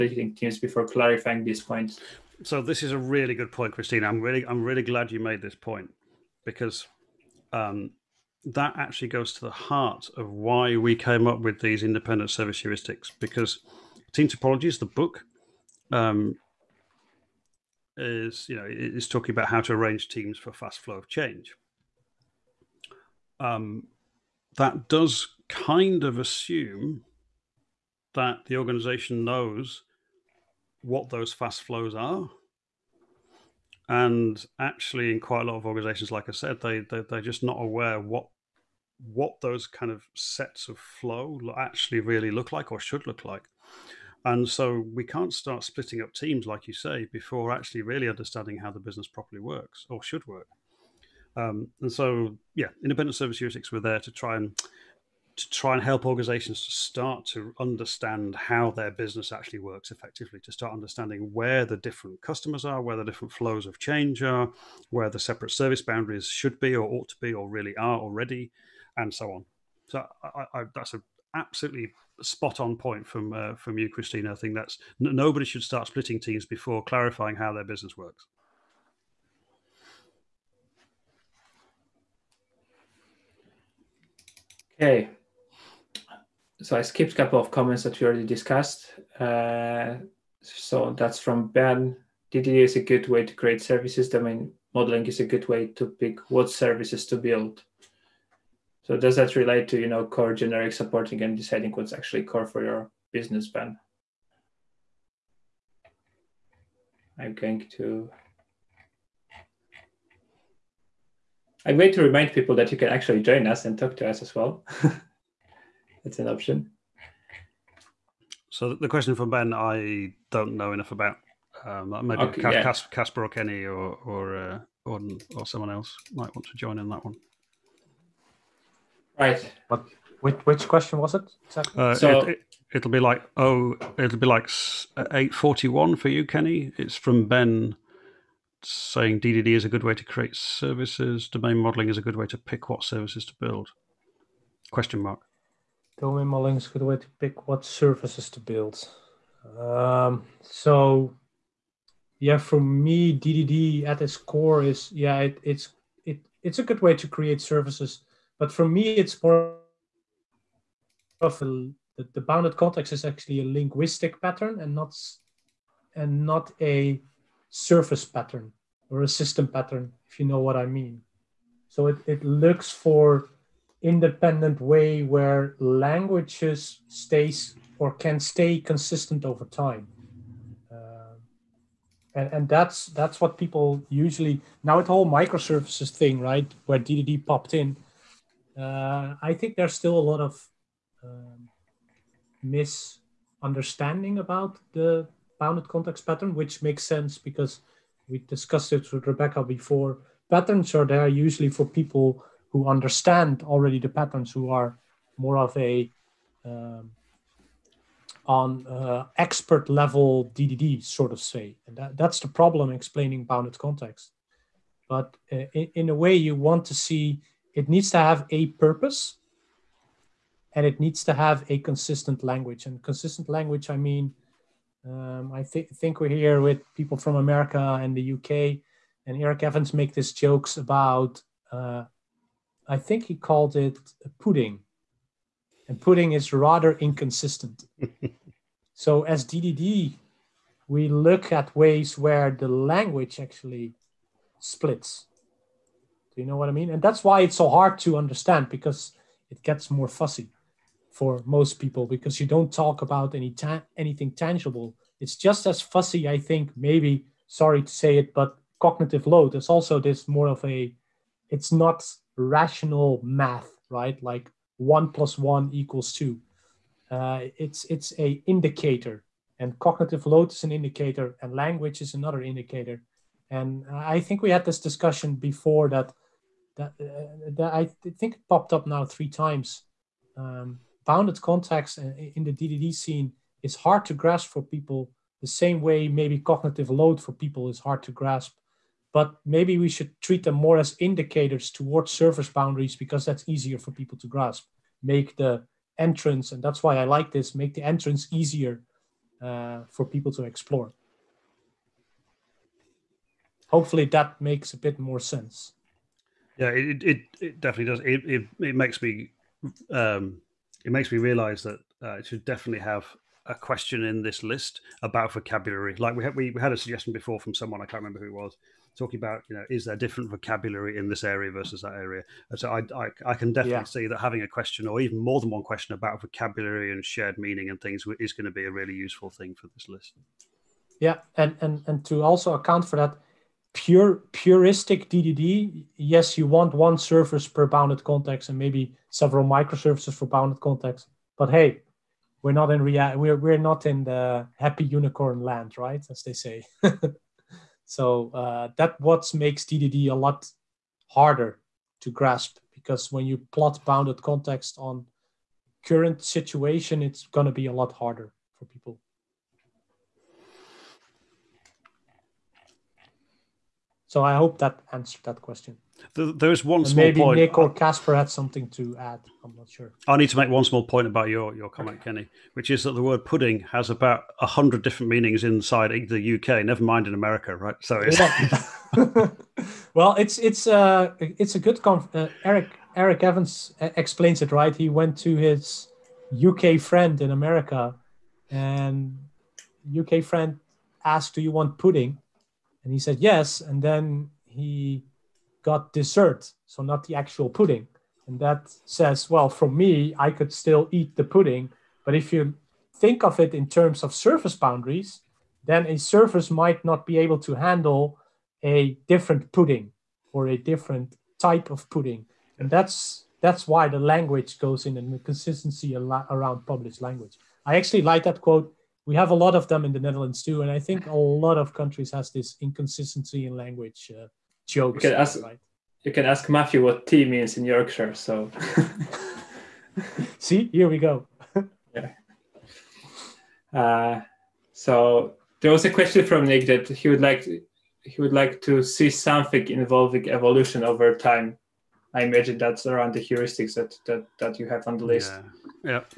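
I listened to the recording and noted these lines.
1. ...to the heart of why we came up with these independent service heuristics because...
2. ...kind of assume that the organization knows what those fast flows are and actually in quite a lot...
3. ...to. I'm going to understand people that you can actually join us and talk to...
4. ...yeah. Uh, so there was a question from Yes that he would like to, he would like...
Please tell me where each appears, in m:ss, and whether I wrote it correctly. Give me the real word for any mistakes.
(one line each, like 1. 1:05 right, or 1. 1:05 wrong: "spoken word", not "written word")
1. 0:09 right
2. 0:25 right
3. 1:47 wrong: "remind", not "understand"
4. 7:11 wrong: "Nick", not "Yes".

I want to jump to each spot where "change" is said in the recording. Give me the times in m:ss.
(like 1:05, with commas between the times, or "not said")
0:21, 1:03.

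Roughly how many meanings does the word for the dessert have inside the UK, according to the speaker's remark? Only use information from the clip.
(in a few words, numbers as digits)
100.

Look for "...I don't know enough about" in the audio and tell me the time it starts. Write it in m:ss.
1:59.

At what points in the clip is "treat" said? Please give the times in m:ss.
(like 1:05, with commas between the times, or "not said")
4:50.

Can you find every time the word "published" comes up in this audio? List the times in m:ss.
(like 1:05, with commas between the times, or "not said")
6:56.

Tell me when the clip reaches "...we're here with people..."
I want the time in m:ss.
3:46.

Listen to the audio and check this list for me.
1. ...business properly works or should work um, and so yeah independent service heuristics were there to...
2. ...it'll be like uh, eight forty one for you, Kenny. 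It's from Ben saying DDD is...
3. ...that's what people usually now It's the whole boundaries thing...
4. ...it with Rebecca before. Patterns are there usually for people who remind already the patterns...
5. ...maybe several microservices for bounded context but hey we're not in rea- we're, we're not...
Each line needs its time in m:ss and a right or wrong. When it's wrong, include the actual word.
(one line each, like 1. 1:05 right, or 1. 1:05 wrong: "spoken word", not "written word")
1. 0:48 right
2. 2:13 right
3. 3:02 wrong: "microservices", not "boundaries"
4. 3:18 wrong: "understand", not "remind"
5. 5:38 right.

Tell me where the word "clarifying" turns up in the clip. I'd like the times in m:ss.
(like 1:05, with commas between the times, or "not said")
0:00, 1:16.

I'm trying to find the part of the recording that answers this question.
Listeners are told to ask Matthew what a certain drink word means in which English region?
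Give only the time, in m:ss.
7:07.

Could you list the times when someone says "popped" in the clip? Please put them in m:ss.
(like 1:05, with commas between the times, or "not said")
3:07, 4:38.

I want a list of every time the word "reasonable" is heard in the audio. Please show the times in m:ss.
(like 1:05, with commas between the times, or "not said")
not said.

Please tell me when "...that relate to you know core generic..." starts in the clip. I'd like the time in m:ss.
1:39.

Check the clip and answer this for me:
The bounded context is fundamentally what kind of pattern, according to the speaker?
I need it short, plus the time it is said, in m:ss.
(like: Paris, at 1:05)
A linguistic pattern, at 2:43.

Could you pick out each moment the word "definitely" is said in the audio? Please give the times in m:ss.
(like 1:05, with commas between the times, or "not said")
5:07, 5:12, 5:23.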